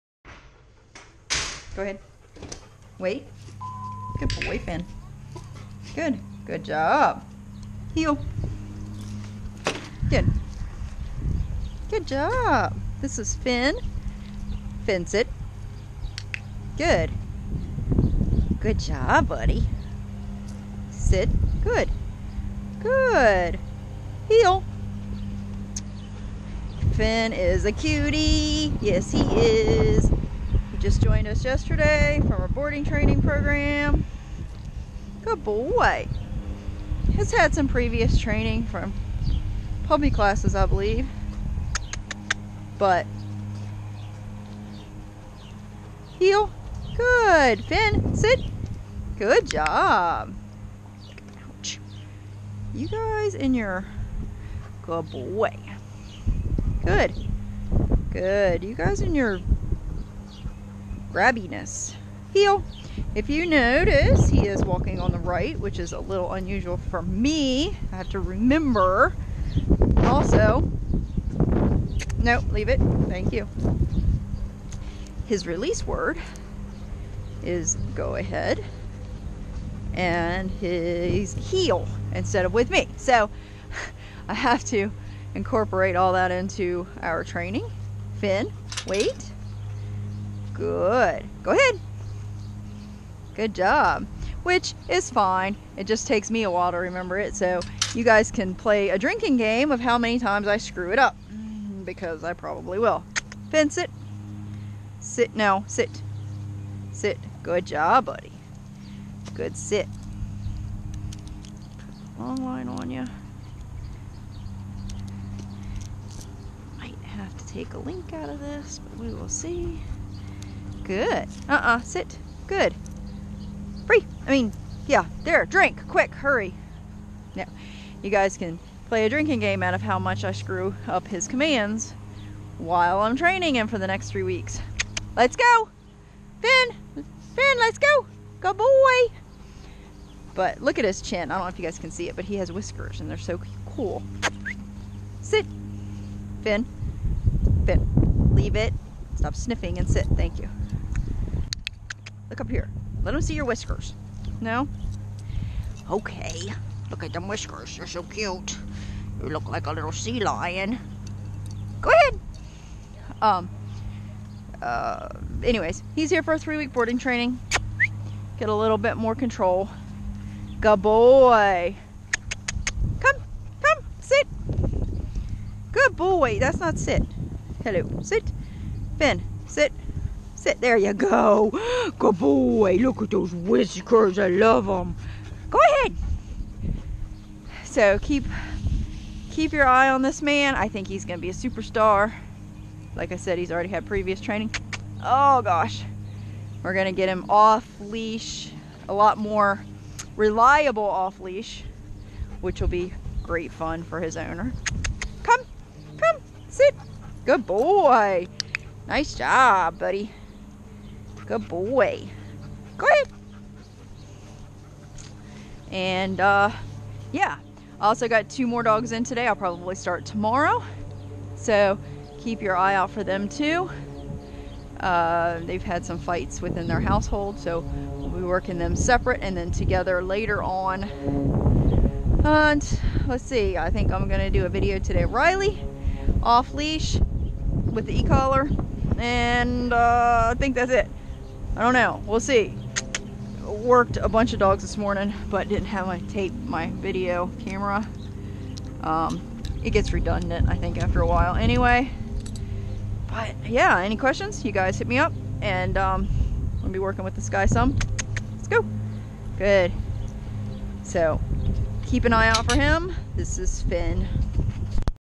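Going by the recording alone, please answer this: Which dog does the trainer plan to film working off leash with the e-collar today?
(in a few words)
Riley.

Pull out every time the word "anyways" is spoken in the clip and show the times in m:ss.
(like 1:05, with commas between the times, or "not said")
2:45, 4:11.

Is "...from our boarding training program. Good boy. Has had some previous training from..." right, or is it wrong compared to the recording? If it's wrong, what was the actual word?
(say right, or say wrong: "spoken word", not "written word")
right.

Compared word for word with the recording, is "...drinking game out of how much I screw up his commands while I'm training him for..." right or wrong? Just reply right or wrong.
right.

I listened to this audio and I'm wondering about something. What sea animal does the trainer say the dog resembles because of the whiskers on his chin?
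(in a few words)
Sea lion.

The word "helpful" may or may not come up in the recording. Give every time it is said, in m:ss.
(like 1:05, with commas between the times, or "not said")
not said.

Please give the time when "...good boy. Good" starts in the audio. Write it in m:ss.
0:54.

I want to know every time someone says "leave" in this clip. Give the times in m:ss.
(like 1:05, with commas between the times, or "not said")
1:12, 2:28.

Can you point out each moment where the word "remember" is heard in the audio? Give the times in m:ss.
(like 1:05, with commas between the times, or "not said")
1:08, 1:36.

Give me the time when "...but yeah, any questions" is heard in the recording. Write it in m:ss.
4:13.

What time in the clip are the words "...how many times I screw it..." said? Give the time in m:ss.
1:39.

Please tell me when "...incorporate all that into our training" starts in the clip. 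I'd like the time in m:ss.
1:25.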